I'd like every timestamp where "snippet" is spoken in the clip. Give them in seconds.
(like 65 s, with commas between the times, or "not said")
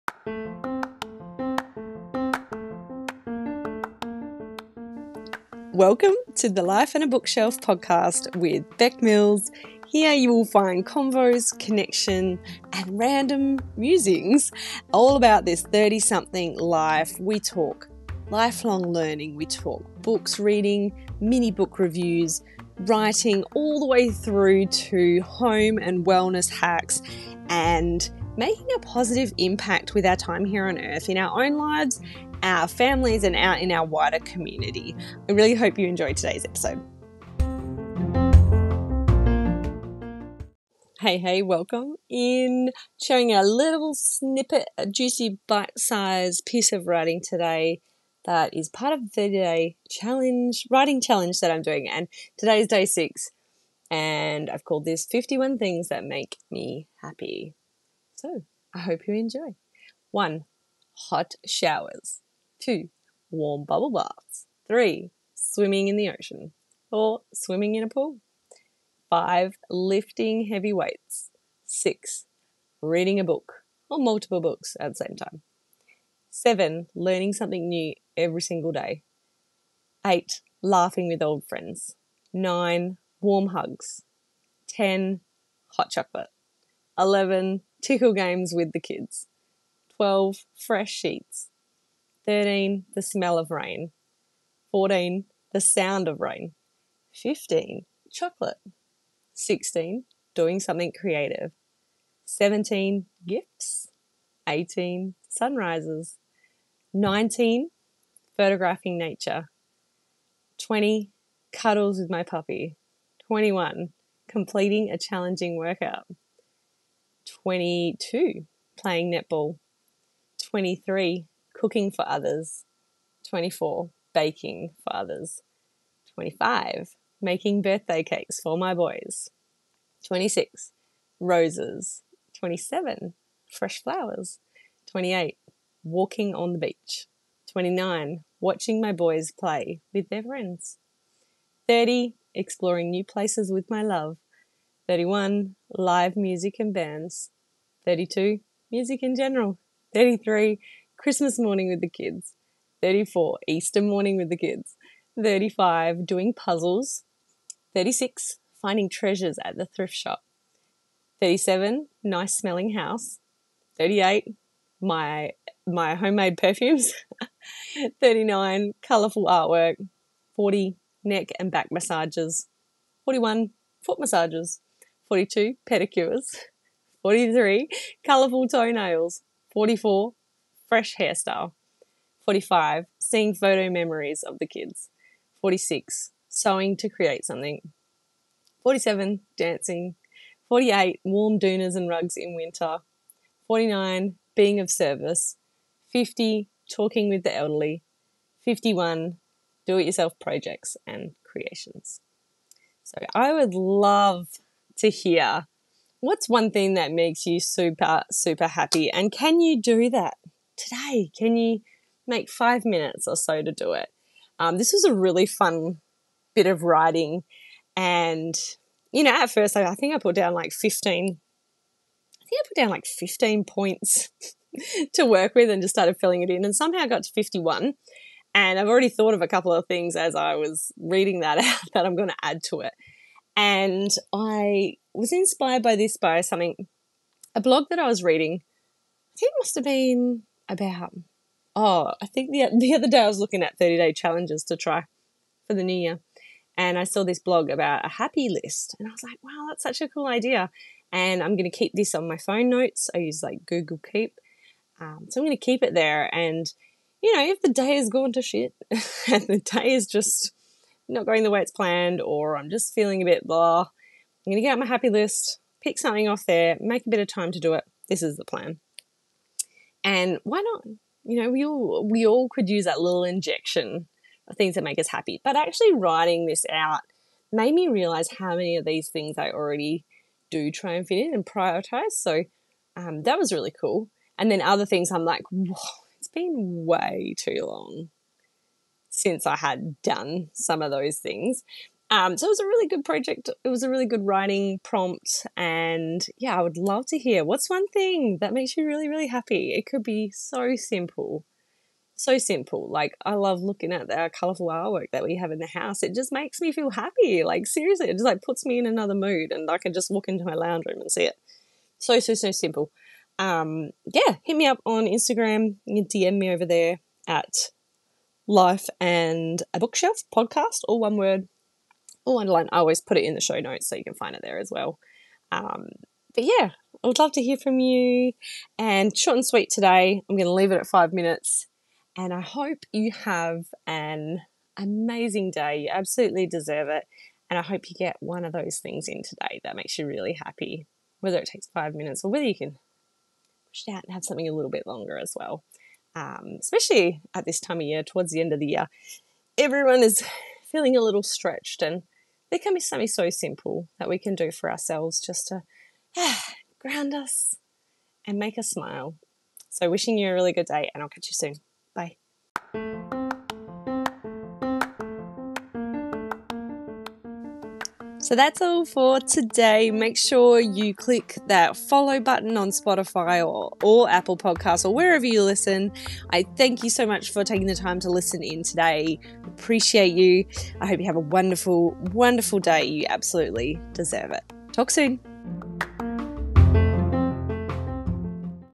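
43 s.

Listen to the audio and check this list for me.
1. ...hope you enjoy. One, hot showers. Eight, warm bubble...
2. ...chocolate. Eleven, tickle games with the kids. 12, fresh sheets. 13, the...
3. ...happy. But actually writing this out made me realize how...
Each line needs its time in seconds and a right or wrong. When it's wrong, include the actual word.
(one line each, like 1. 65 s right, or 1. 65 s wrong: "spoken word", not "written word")
1. 58 s wrong: "Two", not "Eight"
2. 85 s right
3. 274 s right.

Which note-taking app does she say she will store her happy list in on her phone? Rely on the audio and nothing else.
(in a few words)
Google Keep.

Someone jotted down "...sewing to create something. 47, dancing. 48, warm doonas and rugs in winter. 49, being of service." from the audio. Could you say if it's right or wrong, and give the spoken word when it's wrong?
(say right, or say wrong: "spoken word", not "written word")
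right.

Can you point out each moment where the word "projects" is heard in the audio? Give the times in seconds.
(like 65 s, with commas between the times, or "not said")
200 s, 292 s.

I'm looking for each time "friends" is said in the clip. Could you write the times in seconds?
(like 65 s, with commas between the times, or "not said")
81 s, 140 s.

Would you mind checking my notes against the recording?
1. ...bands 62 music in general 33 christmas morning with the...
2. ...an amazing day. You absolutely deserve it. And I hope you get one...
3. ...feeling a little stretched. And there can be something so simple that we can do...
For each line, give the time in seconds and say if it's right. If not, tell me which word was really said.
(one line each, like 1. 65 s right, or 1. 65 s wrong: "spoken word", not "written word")
1. 146 s wrong: "32", not "62"
2. 333 s right
3. 350 s right.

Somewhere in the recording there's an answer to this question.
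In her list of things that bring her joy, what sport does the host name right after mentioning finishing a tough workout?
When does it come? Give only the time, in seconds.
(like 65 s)
119 s.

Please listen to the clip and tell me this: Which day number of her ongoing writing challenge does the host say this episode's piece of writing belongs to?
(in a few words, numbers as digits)
6.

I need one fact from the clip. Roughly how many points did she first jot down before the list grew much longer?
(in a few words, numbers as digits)
15.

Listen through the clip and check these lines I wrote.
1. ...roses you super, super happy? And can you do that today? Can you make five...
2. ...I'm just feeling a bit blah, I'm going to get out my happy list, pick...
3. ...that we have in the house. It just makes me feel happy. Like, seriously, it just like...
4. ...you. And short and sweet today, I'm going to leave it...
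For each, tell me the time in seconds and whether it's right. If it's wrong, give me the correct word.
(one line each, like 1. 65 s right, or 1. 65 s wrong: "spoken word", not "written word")
1. 206 s wrong: "makes", not "roses"
2. 262 s right
3. 304 s right
4. 327 s right.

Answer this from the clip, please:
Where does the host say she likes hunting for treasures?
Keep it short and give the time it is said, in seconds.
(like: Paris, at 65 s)
The thrift shop, at 159 s.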